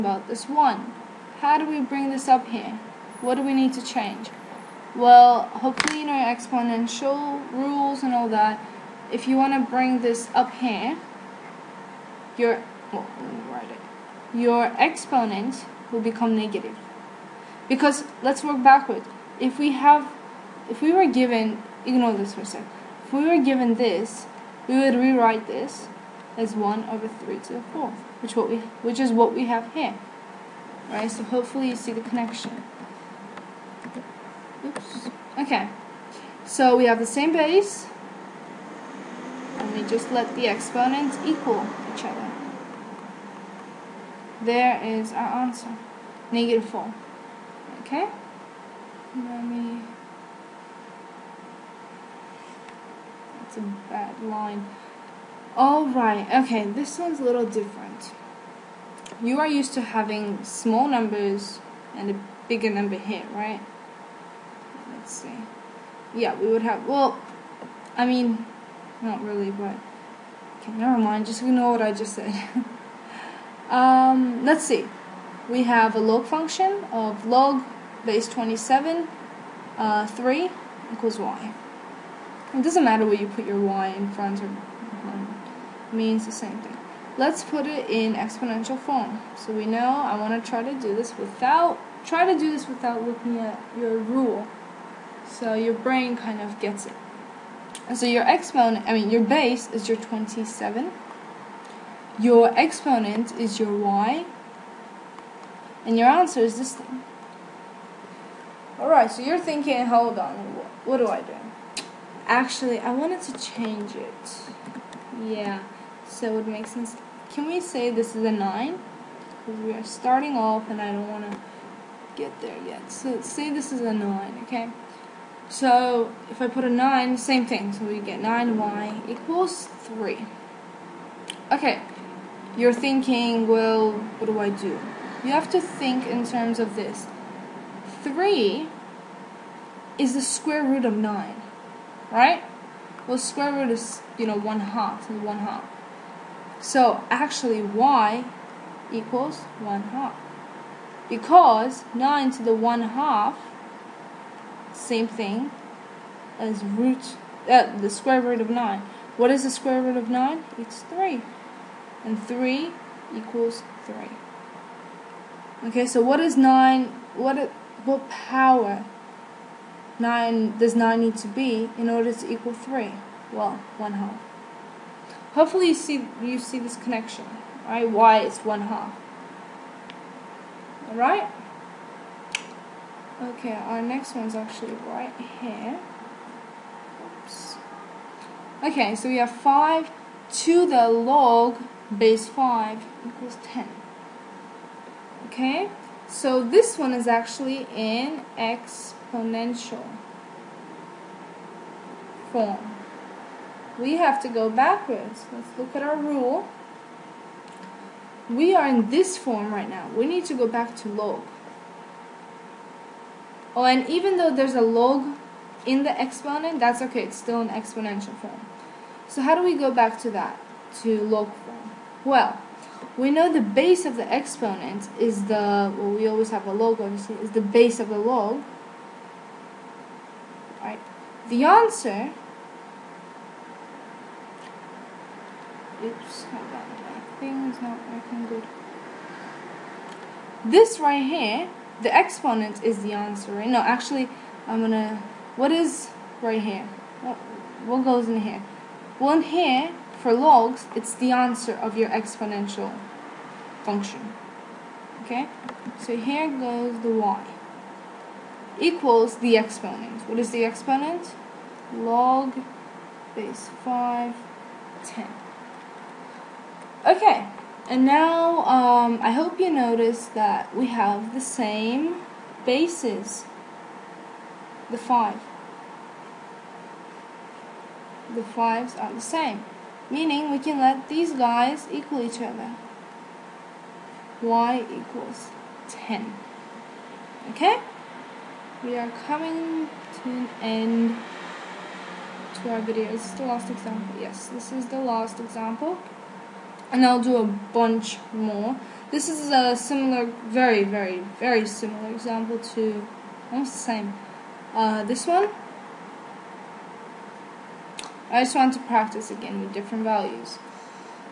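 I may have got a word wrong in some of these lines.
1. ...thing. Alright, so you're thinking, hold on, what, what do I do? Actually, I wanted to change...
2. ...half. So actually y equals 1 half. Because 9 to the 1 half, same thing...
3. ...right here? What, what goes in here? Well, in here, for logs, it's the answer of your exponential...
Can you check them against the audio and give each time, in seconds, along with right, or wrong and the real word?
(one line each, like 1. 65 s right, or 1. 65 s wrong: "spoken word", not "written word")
1. 106 s right
2. 145 s right
3. 246 s right.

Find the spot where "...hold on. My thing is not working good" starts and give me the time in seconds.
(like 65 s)
236 s.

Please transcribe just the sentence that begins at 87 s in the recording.
Let's put it in exponential form.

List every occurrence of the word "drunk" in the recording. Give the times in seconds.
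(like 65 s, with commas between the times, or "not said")
not said.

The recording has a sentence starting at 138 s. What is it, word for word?
3 is the square root of 9, right?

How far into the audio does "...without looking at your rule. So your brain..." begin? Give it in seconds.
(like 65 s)
92 s.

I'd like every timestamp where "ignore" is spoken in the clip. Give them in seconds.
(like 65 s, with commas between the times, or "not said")
21 s, 71 s.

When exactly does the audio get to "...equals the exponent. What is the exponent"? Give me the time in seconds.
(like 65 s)
258 s.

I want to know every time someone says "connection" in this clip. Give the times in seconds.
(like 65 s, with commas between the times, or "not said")
32 s, 176 s.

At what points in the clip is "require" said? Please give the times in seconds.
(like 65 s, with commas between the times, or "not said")
not said.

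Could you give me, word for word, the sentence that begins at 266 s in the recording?
Okay, and now um, I hope you notice that we have the same bases, the five.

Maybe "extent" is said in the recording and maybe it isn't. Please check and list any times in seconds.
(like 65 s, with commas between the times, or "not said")
not said.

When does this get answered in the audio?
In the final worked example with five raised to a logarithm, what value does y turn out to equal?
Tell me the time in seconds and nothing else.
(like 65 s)
284 s.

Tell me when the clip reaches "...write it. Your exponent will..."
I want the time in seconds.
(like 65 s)
13 s.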